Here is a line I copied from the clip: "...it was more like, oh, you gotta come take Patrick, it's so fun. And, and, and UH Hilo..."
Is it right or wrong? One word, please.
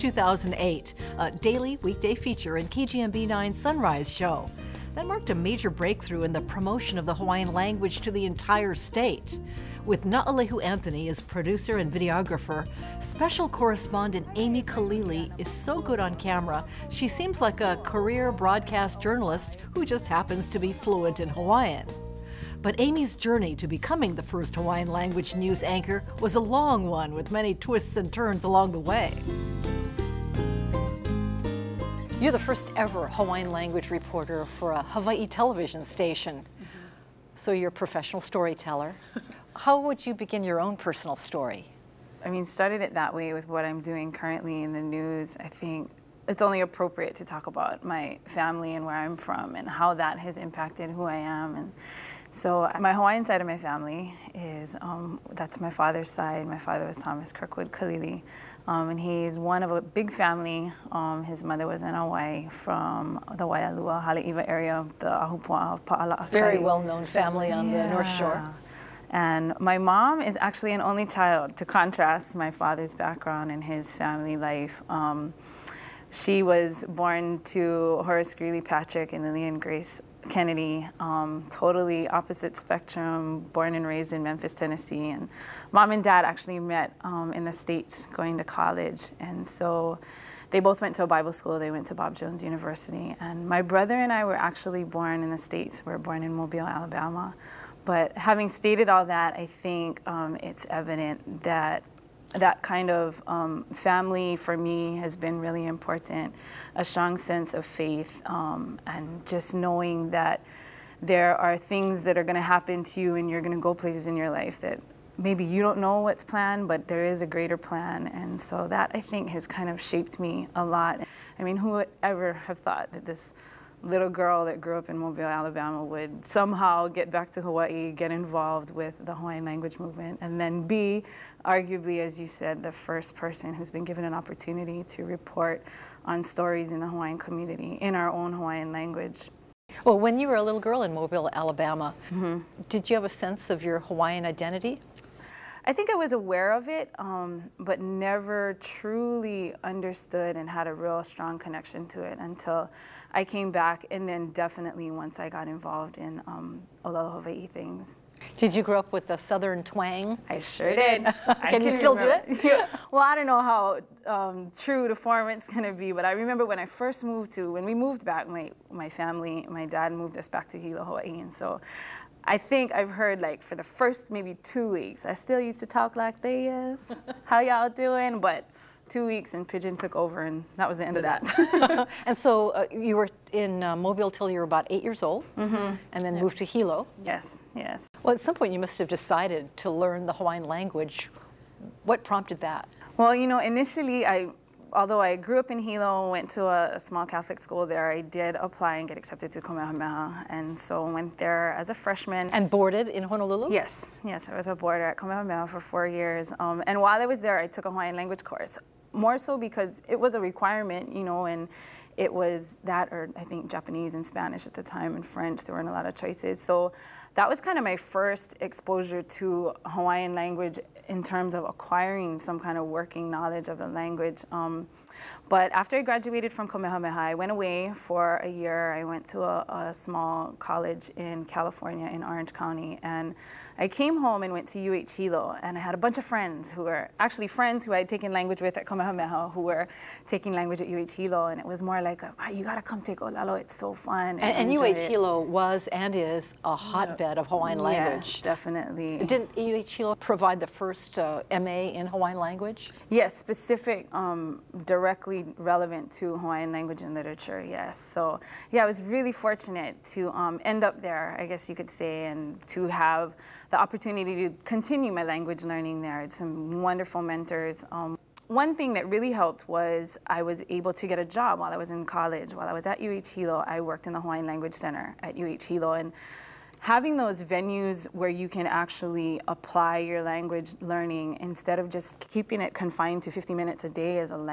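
wrong.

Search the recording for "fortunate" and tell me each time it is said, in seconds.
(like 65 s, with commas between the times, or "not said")
259 s.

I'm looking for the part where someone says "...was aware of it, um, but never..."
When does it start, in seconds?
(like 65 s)
145 s.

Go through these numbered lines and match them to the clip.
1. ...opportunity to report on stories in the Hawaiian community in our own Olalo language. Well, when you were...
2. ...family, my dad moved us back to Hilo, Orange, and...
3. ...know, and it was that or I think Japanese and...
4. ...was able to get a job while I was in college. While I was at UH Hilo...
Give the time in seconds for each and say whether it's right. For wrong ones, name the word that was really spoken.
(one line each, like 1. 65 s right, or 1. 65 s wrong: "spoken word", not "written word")
1. 134 s wrong: "Hawaiian", not "Olalo"
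2. 168 s wrong: "Hawaii", not "Orange"
3. 211 s right
4. 270 s right.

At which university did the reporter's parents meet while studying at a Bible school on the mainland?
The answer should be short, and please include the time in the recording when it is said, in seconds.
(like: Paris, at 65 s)
Bob Jones University, at 91 s.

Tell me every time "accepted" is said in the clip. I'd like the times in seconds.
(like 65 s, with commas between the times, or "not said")
198 s.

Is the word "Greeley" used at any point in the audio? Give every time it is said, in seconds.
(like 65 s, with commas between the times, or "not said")
78 s.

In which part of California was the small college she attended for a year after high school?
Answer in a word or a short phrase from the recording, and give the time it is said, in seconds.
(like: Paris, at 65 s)
Orange County, at 232 s.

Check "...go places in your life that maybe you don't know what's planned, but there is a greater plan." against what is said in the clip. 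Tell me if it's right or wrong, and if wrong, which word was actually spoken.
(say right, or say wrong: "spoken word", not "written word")
right.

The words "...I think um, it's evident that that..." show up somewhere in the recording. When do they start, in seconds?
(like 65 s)
99 s.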